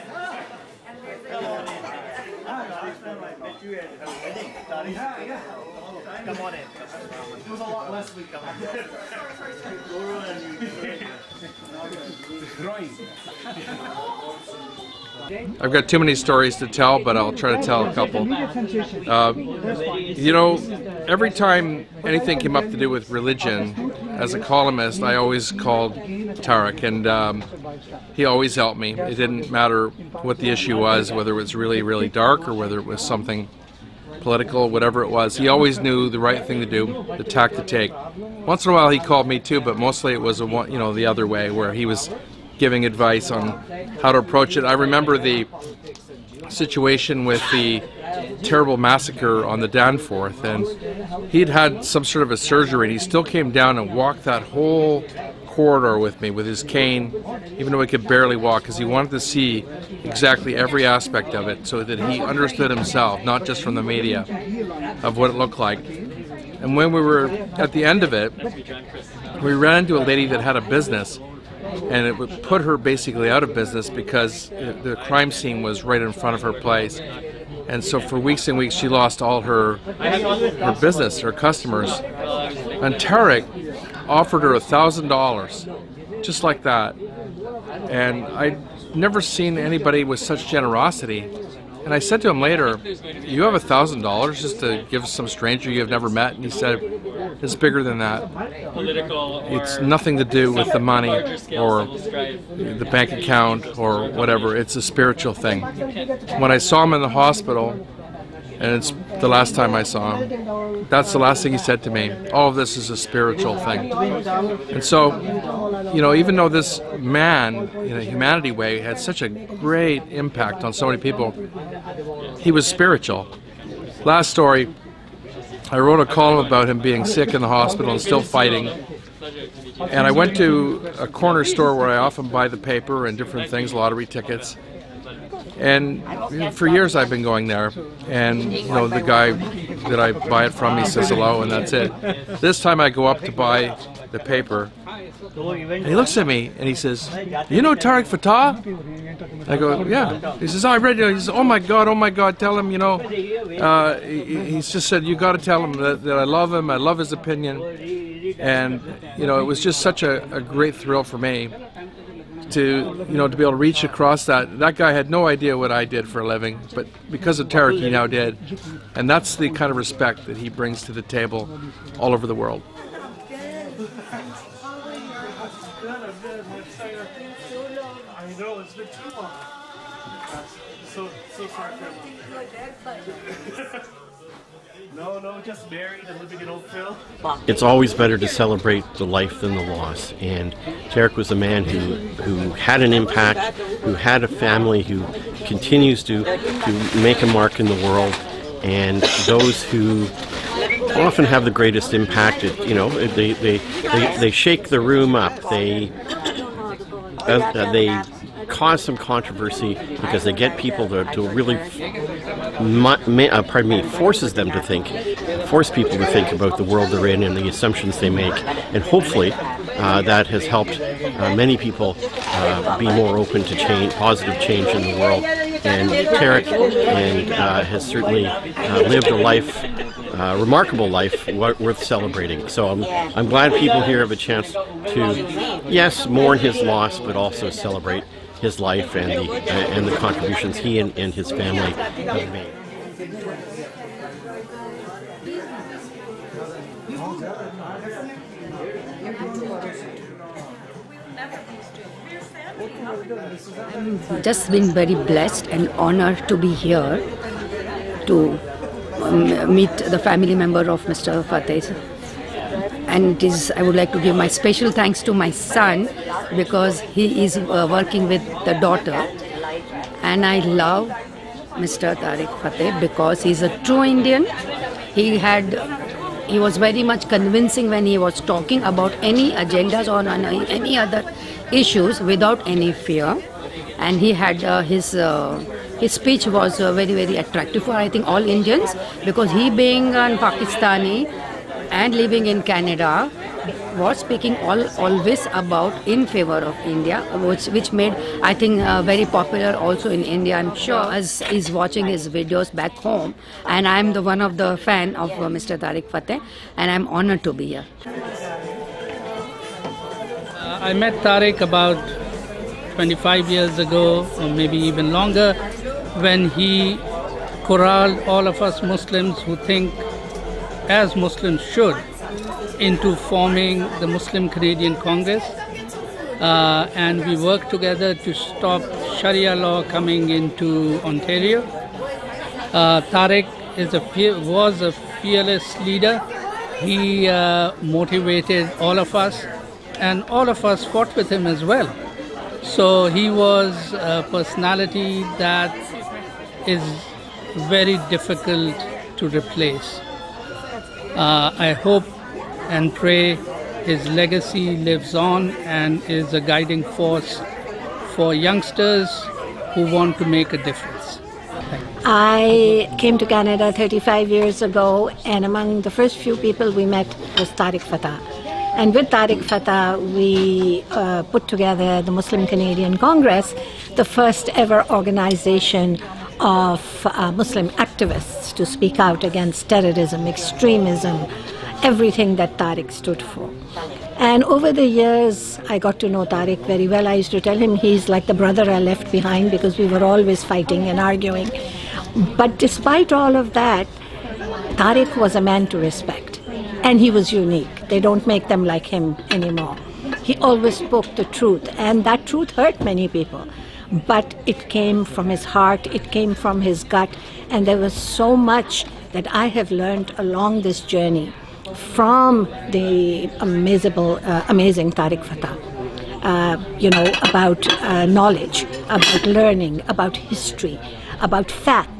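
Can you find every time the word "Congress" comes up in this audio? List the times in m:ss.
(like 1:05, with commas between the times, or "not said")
5:24, 6:12.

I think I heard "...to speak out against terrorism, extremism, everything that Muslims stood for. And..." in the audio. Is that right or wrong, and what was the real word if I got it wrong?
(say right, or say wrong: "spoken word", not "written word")
wrong: "Tarek", not "Muslims".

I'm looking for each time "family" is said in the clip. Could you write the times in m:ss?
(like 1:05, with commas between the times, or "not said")
3:14, 4:01, 4:19.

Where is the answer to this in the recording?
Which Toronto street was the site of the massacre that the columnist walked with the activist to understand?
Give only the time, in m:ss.
0:49.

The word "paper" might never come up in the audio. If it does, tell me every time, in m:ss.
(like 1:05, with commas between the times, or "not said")
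2:12, 2:24.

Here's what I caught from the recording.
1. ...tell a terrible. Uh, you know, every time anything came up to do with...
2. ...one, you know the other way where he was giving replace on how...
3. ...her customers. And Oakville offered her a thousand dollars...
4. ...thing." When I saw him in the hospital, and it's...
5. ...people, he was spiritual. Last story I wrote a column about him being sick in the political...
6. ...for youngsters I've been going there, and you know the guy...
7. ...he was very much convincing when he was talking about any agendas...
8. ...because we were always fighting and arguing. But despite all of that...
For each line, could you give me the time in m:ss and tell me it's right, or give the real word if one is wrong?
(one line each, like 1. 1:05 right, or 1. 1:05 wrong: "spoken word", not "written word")
1. 0:17 wrong: "couple", not "terrible"
2. 0:40 wrong: "advice", not "replace"
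3. 1:21 wrong: "Tarek", not "Oakville"
4. 1:45 right
5. 2:00 wrong: "hospital", not "political"
6. 2:16 wrong: "years", not "youngsters"
7. 4:36 right
8. 6:29 right.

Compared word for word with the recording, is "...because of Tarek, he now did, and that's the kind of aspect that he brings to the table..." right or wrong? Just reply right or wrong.
wrong.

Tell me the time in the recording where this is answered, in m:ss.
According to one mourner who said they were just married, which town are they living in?
3:06.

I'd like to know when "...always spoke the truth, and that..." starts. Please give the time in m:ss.
6:40.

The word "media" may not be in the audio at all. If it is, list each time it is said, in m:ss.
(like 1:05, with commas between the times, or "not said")
1:03.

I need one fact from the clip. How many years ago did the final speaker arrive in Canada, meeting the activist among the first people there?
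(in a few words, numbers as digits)
35.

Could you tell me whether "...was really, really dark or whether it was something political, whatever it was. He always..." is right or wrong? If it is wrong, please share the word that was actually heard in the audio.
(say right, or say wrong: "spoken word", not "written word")
right.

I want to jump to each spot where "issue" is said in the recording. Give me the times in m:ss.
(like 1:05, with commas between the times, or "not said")
0:30, 4:41.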